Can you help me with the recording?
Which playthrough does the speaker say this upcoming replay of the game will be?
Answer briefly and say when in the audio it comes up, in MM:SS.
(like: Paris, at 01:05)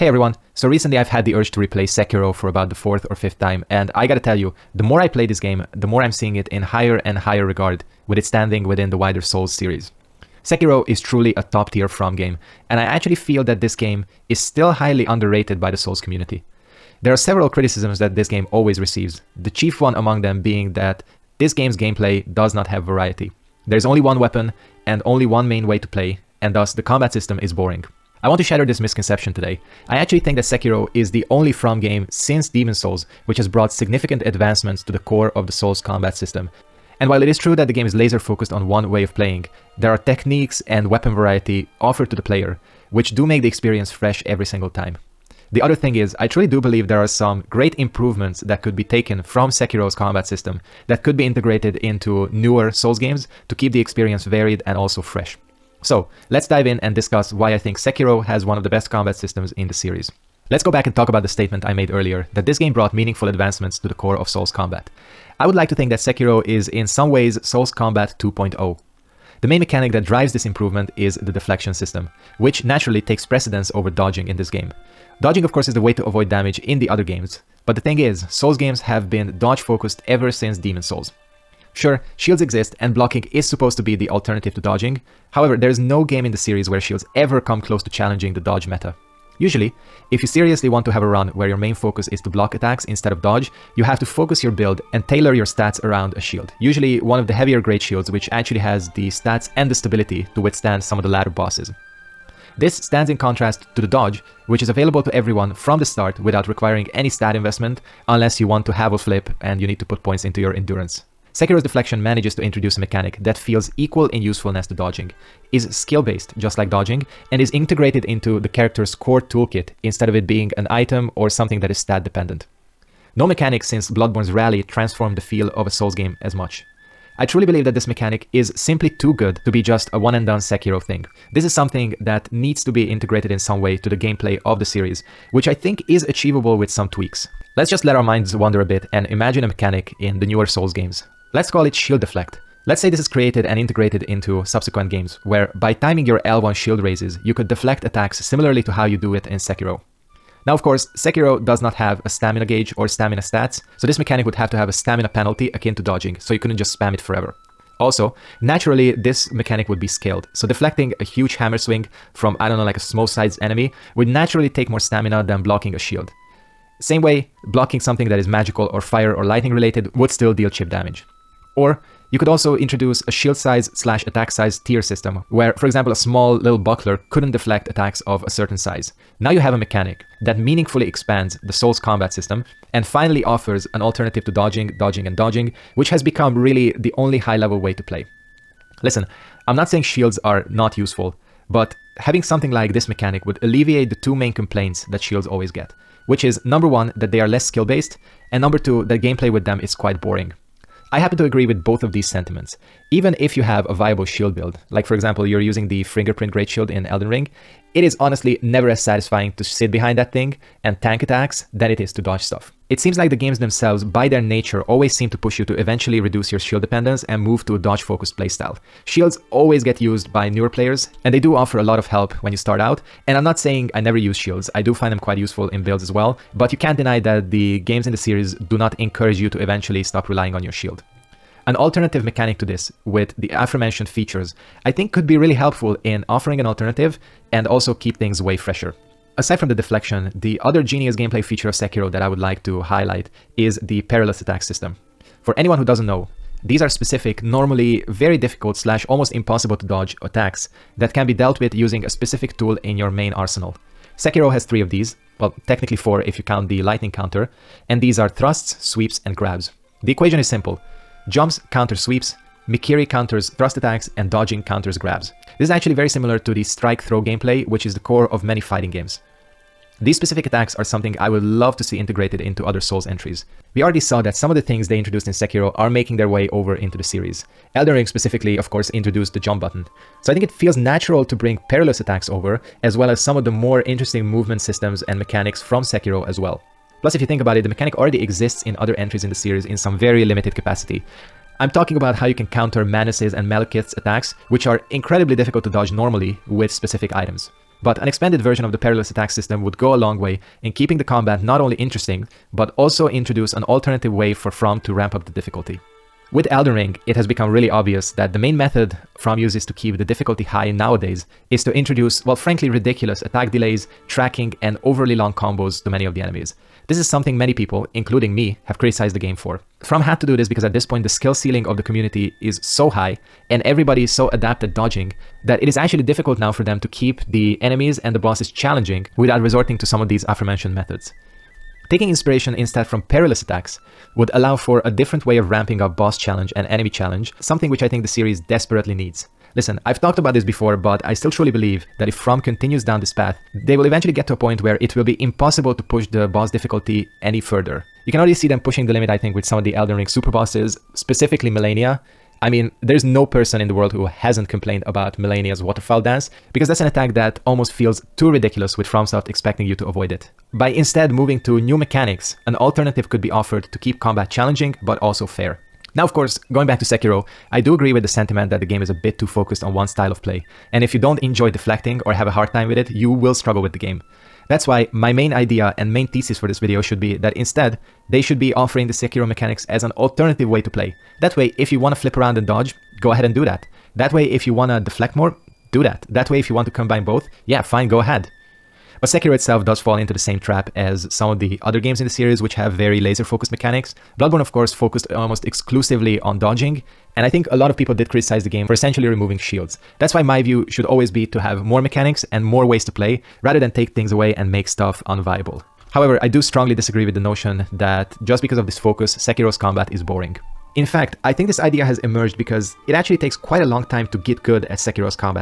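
fourth or fifth, at 00:02.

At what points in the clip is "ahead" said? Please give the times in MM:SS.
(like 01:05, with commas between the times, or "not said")
06:22, 06:27.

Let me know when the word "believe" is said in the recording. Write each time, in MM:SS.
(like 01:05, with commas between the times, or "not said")
00:46, 02:07, 05:41.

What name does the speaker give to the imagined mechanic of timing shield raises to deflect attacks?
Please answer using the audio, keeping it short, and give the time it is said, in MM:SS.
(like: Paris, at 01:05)
shield deflect, at 02:21.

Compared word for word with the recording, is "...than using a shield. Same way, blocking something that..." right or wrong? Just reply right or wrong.
wrong.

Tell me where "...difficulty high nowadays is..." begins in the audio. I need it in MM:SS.
05:09.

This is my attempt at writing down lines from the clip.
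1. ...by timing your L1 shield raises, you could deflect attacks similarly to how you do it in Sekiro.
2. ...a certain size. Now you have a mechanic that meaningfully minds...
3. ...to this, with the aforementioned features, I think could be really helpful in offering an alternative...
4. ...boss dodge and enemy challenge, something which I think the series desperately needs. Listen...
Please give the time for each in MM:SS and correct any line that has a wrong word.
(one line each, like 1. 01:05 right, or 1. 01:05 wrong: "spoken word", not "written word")
1. 02:25 right
2. 02:58 wrong: "expands", not "minds"
3. 03:52 right
4. 05:35 wrong: "challenge", not "dodge".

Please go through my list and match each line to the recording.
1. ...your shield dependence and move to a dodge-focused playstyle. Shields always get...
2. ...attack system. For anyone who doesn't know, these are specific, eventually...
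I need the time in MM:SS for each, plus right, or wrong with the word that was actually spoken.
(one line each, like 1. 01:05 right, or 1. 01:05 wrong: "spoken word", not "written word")
1. 03:36 right
2. 04:04 wrong: "normally", not "eventually".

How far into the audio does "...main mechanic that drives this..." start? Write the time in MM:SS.
01:09.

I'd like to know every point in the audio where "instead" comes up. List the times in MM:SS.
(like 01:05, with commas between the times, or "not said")
01:32, 01:59, 05:32, 06:00, 06:17.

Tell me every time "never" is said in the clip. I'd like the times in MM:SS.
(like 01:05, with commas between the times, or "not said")
03:28, 03:43.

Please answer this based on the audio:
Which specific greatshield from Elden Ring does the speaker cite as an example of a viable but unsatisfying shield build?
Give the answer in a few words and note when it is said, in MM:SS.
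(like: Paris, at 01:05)
Fingerprint Great Shield, at 03:25.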